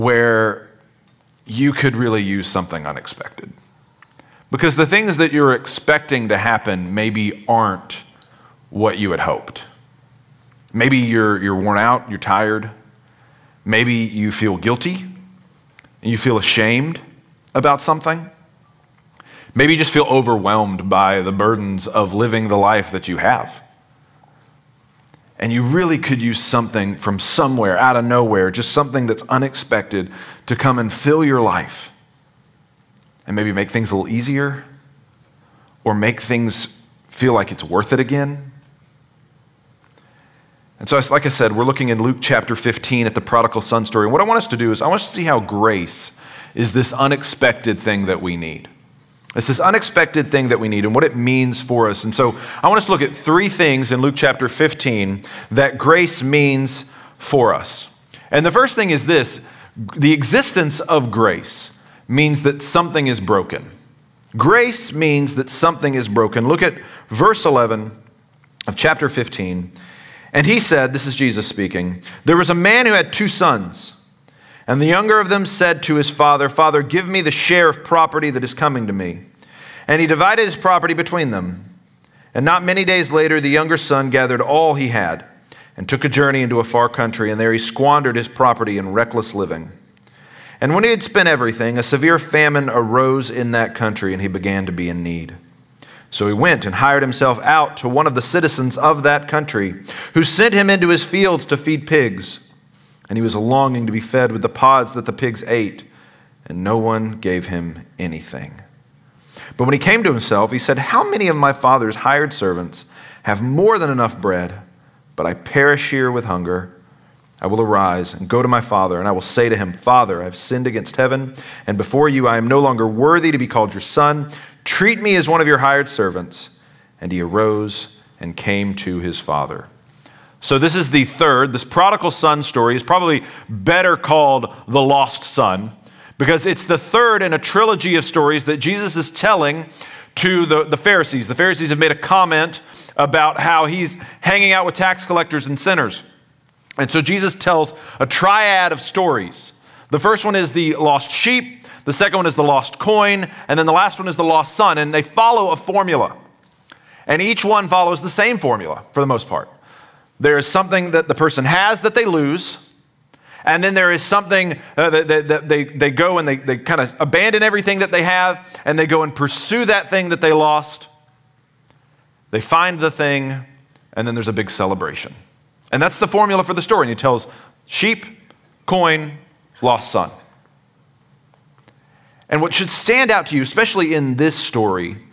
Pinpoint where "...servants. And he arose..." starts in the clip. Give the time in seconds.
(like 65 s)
125 s.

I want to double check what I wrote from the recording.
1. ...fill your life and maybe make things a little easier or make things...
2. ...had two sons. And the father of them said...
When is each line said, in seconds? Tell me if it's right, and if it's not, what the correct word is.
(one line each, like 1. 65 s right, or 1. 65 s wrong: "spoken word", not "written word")
1. 30 s right
2. 72 s wrong: "younger", not "father".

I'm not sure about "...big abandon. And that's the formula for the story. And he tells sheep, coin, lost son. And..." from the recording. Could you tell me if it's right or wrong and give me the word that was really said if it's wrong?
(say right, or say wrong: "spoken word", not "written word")
wrong: "celebration", not "abandon".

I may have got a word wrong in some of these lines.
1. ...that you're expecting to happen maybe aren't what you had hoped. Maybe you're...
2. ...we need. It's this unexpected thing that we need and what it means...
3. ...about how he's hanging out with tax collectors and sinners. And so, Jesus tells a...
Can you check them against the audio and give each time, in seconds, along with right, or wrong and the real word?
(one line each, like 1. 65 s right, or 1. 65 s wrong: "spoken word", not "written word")
1. 5 s right
2. 48 s right
3. 142 s right.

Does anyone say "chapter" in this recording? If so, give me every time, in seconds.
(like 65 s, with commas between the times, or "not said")
42 s, 54 s, 68 s.